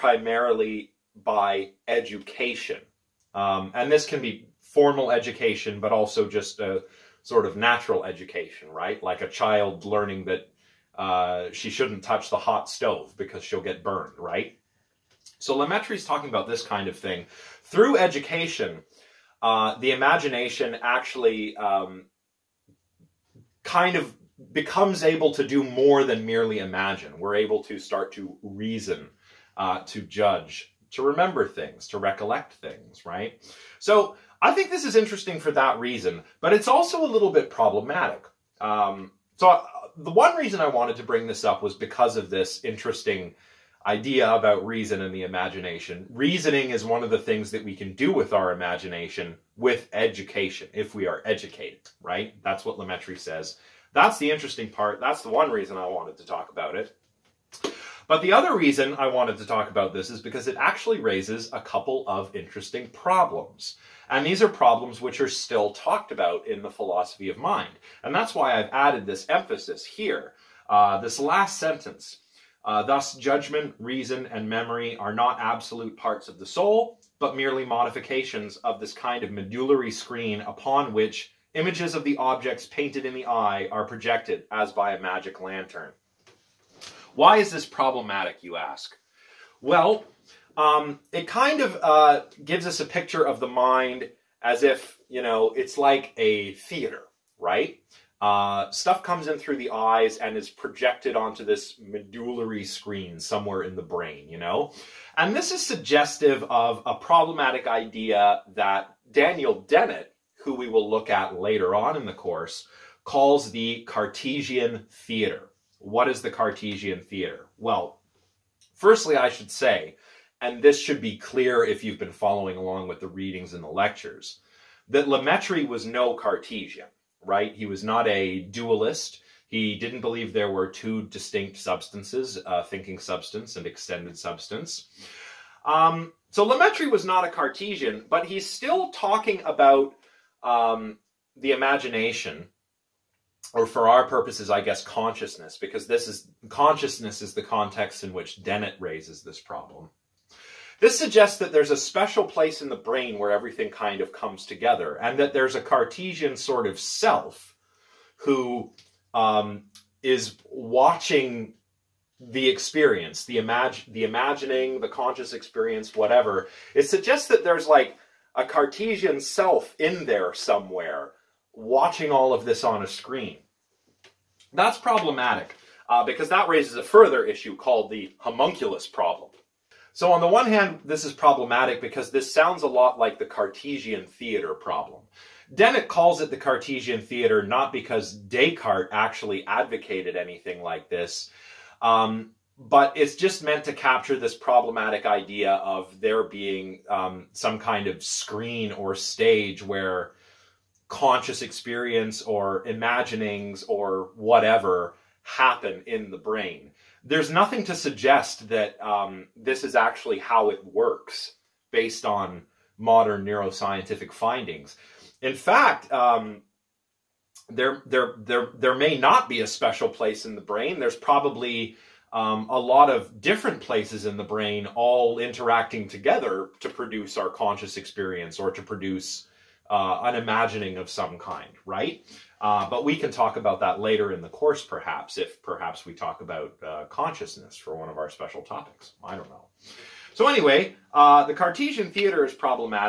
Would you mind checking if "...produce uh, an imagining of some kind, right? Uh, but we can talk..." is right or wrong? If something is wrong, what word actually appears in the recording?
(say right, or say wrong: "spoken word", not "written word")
right.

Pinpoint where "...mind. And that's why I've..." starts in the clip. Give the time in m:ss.
1:07.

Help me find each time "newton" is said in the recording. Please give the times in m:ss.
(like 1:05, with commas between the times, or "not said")
not said.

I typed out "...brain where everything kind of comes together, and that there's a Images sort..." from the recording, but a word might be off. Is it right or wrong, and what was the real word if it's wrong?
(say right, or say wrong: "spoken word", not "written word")
wrong: "Cartesian", not "Images".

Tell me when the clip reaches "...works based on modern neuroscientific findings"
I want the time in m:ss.
3:30.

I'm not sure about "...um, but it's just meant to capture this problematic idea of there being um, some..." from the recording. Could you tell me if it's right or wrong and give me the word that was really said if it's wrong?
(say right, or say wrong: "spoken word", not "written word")
right.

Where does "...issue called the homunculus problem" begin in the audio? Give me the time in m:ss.
2:57.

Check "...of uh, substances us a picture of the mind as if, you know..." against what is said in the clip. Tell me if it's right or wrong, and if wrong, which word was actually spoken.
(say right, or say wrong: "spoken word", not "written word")
wrong: "gives", not "substances".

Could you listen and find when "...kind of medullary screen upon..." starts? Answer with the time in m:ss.
1:18.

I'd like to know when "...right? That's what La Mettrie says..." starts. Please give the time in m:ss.
0:51.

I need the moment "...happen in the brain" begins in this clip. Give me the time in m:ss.
3:25.